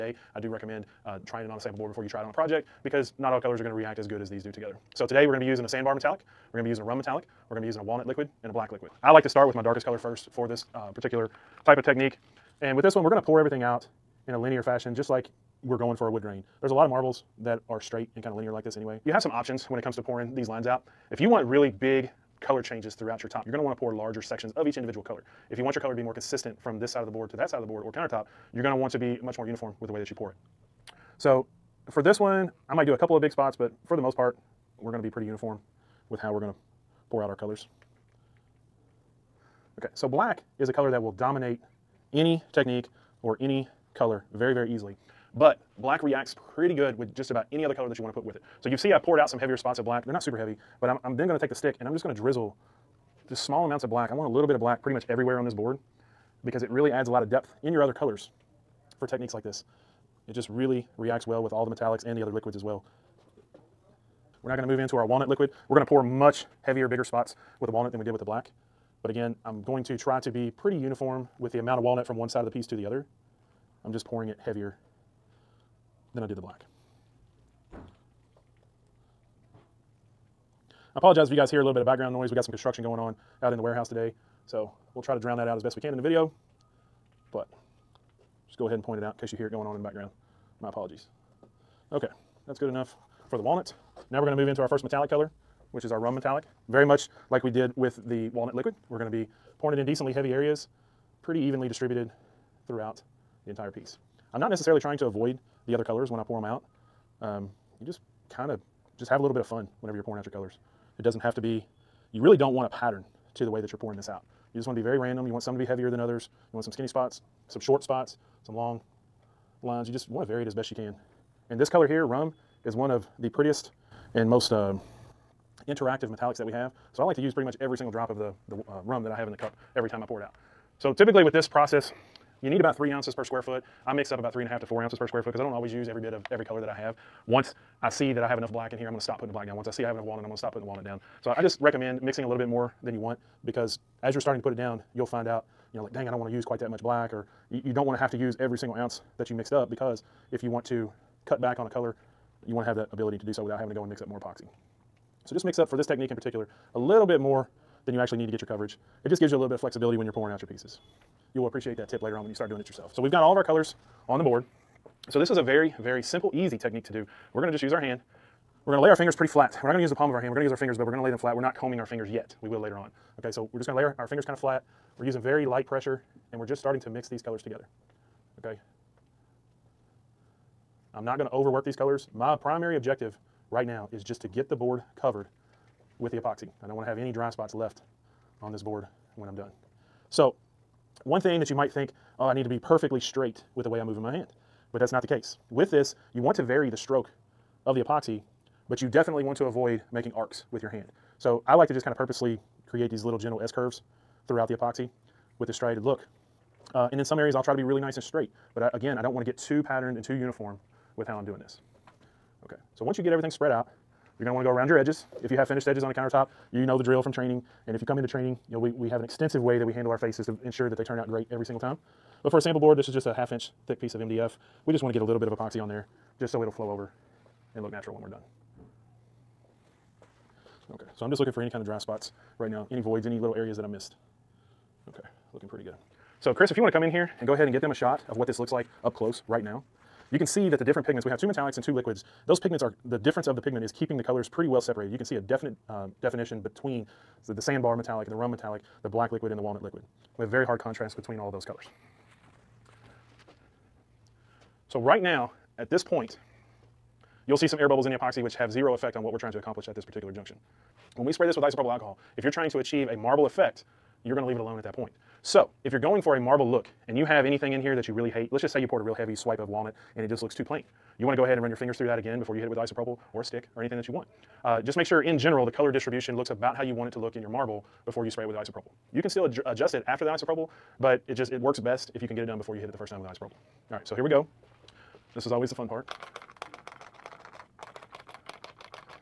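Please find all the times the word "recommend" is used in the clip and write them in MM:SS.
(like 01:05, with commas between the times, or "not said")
00:00, 02:21.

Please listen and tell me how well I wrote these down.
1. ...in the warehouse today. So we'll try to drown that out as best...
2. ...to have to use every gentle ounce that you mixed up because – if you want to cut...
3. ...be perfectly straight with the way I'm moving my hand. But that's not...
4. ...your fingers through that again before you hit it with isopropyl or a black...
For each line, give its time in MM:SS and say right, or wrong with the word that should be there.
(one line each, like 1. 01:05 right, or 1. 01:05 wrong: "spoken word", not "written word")
1. 01:23 right
2. 02:27 wrong: "single", not "gentle"
3. 03:12 right
4. 04:31 wrong: "stick", not "black".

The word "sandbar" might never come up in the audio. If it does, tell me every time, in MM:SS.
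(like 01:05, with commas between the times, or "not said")
00:05, 04:07.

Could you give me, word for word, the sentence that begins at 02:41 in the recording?
You will appreciate that tip later on when you start doing it yourself.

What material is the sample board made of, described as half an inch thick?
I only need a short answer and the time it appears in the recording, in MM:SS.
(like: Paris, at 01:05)
MDF, at 03:43.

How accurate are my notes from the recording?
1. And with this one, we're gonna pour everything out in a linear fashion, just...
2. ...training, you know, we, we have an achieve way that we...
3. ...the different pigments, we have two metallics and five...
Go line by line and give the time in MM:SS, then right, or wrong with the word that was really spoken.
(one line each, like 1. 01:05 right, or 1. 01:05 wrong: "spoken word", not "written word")
1. 00:12 right
2. 03:38 wrong: "extensive", not "achieve"
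3. 04:00 wrong: "two", not "five".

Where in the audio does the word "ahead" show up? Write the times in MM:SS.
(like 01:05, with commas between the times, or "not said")
01:28, 03:57, 04:31.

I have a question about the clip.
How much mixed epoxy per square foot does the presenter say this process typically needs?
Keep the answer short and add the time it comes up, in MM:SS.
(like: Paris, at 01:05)
3 ounces, at 02:12.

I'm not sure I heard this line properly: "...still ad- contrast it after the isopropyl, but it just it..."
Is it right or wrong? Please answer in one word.
wrong.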